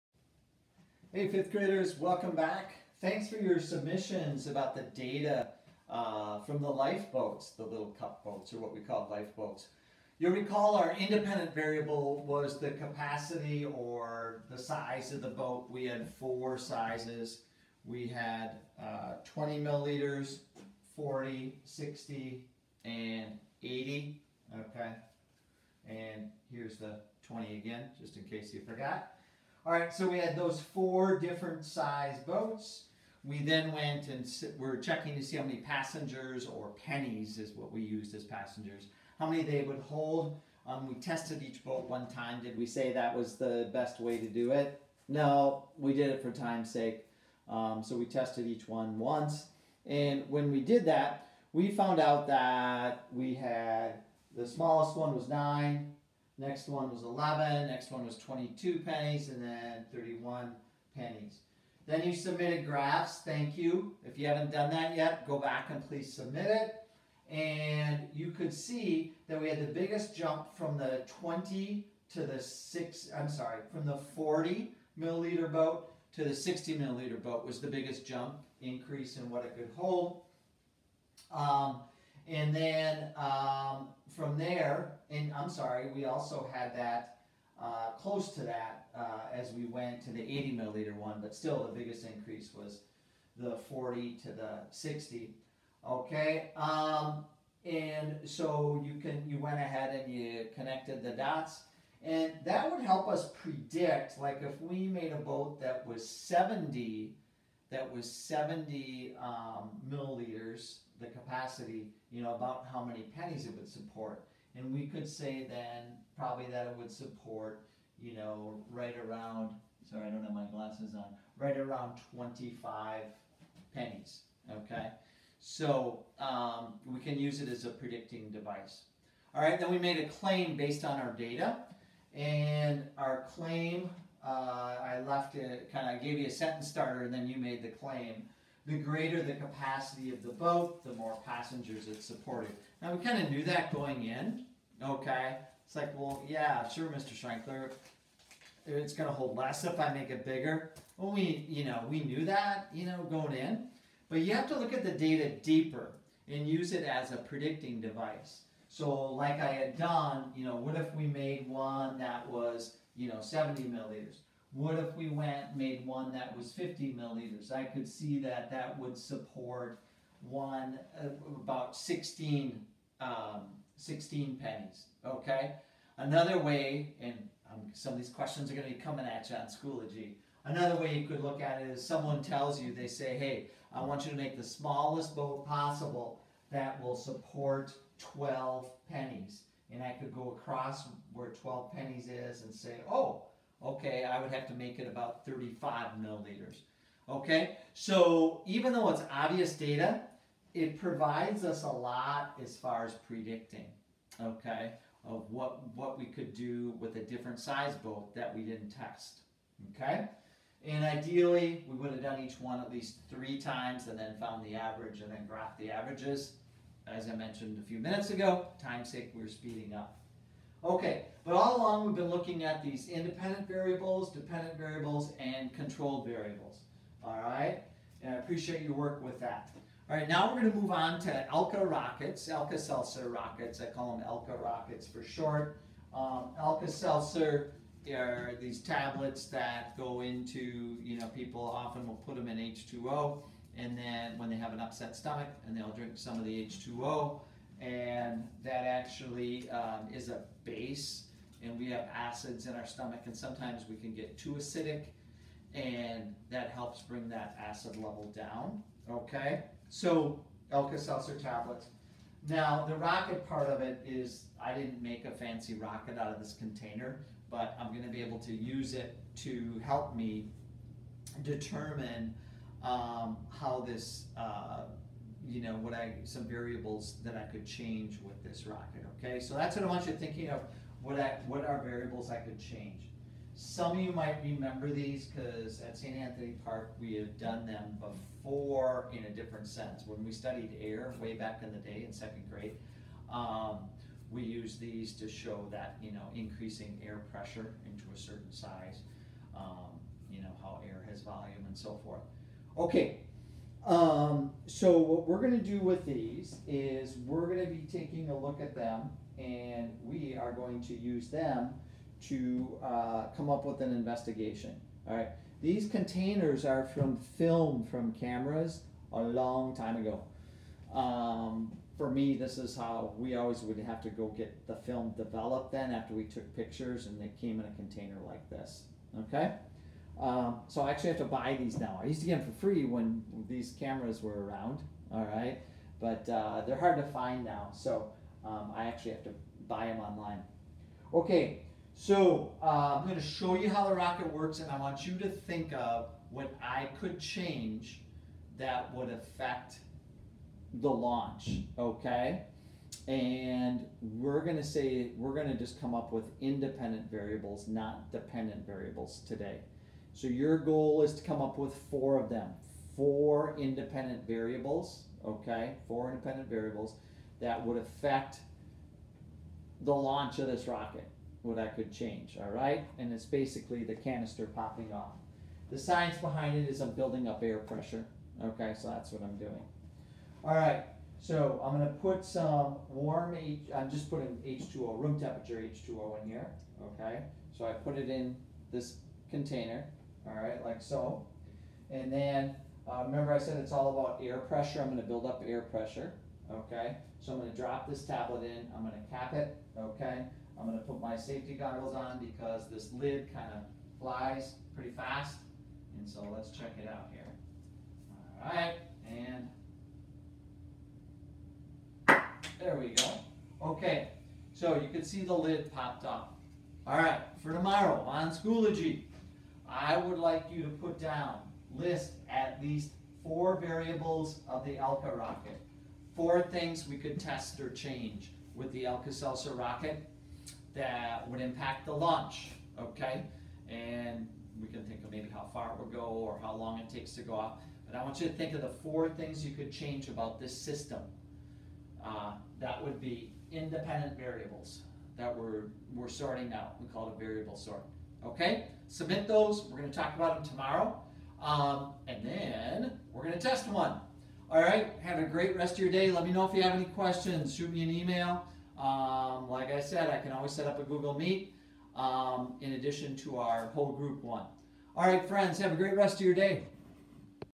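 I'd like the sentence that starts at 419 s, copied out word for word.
I would like you to put down, list at least four variables of the Alka rocket.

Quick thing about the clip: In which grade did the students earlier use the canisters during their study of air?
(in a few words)
second grade.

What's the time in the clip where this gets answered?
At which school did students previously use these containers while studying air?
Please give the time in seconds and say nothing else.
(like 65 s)
285 s.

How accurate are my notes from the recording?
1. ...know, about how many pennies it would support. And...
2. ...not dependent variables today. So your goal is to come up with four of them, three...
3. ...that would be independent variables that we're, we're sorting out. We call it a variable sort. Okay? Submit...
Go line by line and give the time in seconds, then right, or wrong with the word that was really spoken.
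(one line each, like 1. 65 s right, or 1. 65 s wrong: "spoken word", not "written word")
1. 112 s right
2. 357 s wrong: "four", not "three"
3. 442 s right.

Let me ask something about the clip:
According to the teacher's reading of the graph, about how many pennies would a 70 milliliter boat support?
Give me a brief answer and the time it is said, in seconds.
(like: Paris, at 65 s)
25, at 122 s.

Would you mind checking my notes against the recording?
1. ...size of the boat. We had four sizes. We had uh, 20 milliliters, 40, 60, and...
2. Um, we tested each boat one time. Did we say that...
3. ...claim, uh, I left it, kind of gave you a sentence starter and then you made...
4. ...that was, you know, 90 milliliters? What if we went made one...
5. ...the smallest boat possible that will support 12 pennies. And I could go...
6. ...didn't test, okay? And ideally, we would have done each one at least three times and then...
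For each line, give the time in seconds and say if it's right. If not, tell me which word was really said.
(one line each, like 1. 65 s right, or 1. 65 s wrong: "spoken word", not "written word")
1. 14 s right
2. 40 s right
3. 133 s right
4. 161 s wrong: "70", not "90"
5. 184 s right
6. 208 s right.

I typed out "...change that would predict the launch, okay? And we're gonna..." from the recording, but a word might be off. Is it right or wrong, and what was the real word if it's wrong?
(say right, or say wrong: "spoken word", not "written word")
wrong: "affect", not "predict".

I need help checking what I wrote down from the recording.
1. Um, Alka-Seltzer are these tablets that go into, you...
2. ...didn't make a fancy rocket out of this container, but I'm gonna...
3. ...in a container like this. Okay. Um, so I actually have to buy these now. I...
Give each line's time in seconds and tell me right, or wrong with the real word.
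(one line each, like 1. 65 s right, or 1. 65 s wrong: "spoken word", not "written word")
1. 235 s right
2. 264 s right
3. 327 s right.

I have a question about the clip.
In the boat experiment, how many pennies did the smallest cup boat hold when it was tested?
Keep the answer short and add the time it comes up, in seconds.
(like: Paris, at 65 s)
9, at 55 s.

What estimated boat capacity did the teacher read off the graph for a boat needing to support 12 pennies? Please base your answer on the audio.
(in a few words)
35 milliliters.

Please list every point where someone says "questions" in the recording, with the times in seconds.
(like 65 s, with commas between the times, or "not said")
178 s, 456 s.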